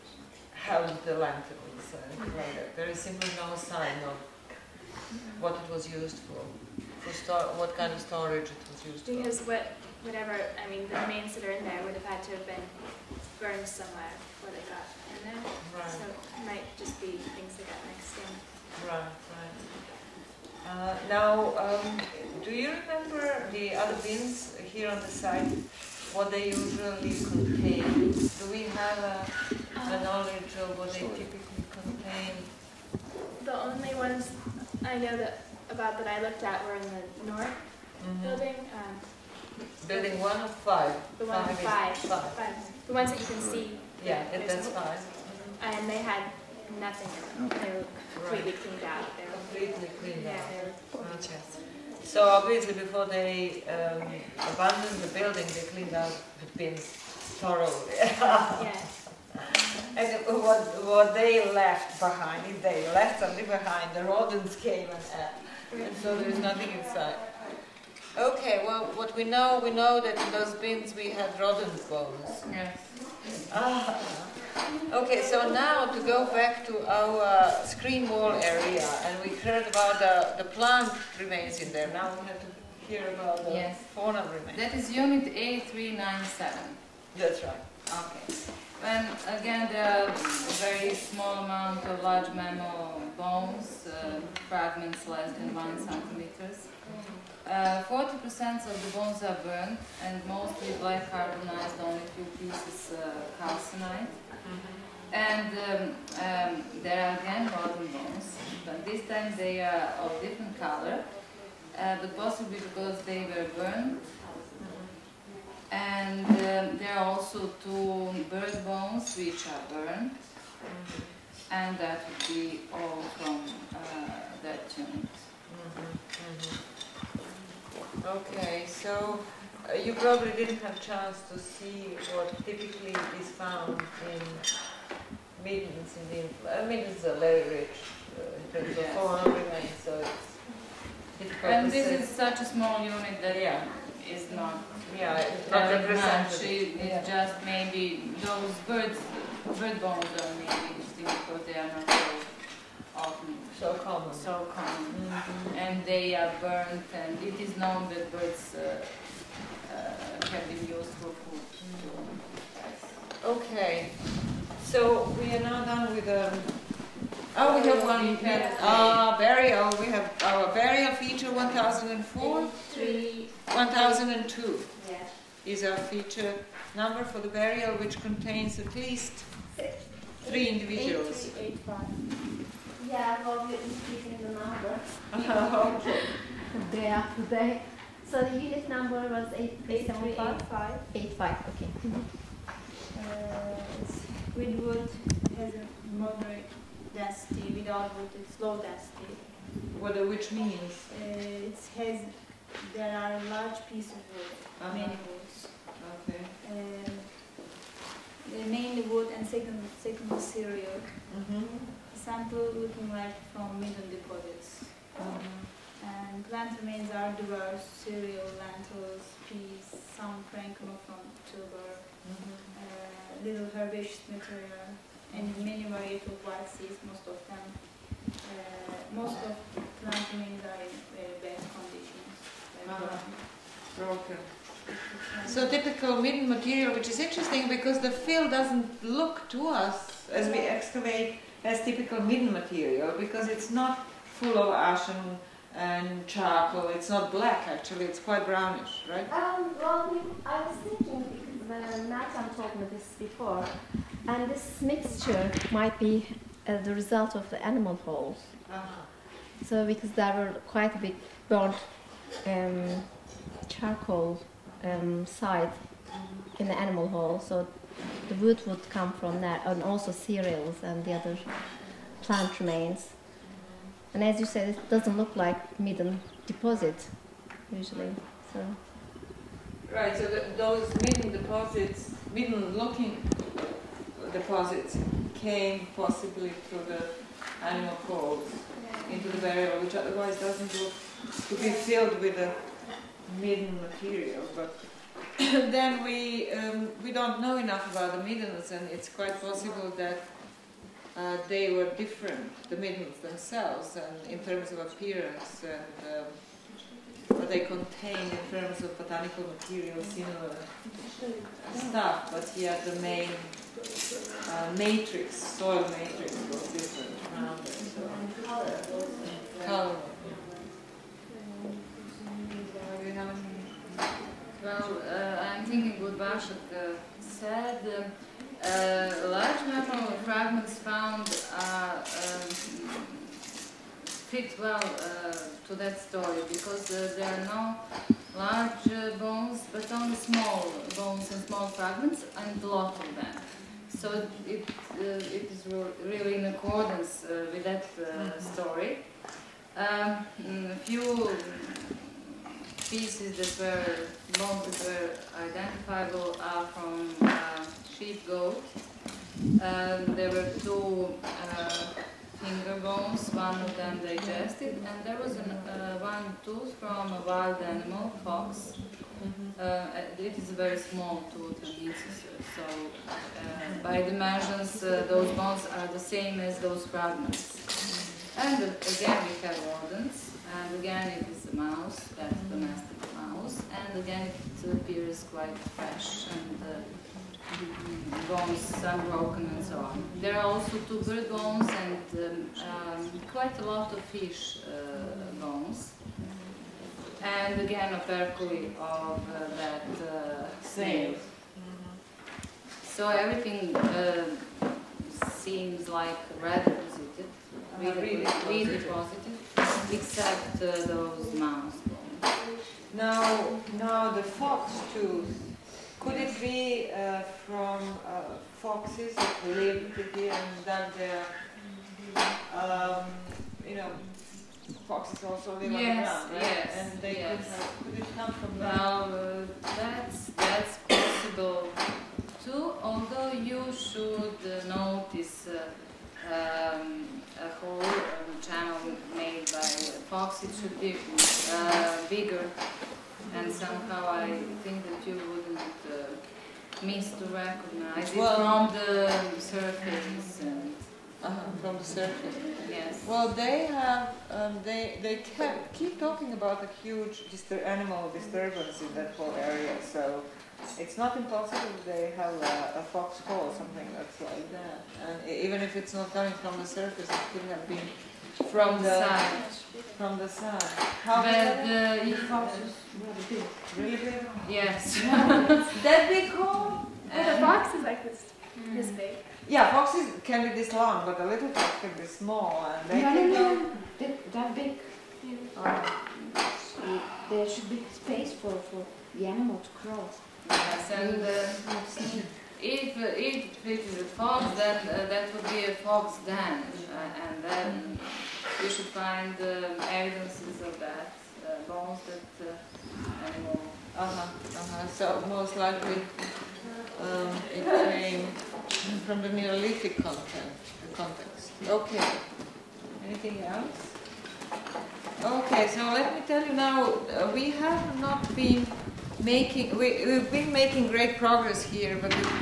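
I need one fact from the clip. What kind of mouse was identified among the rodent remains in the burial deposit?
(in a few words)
domestic mouse.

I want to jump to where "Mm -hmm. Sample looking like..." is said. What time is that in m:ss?
3:31.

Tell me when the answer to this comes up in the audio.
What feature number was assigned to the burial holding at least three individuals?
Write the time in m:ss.
2:53.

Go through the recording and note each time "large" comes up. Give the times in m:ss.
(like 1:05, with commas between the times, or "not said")
1:32, 3:23, 5:29, 5:38.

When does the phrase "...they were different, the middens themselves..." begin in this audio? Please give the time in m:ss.
5:01.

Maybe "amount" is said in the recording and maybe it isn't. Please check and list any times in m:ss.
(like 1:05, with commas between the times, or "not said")
1:31.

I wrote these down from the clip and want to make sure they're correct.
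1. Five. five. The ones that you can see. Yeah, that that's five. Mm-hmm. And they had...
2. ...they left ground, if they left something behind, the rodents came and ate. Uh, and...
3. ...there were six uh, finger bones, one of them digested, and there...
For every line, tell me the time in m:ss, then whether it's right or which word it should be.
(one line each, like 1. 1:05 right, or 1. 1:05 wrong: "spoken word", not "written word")
1. 0:41 right
2. 1:01 wrong: "behind", not "ground"
3. 5:59 wrong: "two", not "six".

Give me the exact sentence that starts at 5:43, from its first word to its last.
So it, it is really in accordance with that mm-hmm.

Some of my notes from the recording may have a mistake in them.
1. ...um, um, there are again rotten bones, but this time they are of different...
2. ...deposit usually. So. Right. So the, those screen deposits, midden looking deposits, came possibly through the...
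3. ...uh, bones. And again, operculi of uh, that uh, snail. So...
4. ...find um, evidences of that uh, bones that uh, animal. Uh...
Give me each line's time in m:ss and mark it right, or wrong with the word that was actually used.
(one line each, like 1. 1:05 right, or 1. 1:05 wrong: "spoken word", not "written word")
1. 1:45 right
2. 4:36 wrong: "midden", not "screen"
3. 6:34 right
4. 8:18 right.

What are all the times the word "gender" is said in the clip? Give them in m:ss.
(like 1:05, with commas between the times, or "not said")
not said.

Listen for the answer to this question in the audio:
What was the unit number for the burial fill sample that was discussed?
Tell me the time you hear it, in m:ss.
3:09.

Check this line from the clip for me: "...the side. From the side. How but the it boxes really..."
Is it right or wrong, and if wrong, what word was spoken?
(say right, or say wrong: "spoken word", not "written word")
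right.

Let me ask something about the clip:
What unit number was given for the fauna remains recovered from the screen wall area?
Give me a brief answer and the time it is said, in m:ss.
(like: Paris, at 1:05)
A397, at 1:25.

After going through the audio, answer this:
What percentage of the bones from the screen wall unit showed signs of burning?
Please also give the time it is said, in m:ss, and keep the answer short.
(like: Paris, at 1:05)
40%, at 1:37.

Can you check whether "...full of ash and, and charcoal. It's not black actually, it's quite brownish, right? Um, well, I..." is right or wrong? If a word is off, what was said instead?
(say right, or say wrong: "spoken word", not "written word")
right.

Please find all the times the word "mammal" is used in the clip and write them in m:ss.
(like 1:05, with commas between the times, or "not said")
1:32, 5:29.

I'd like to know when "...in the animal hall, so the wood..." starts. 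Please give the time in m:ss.
4:26.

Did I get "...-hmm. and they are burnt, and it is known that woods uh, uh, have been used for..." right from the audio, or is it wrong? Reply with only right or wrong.
wrong.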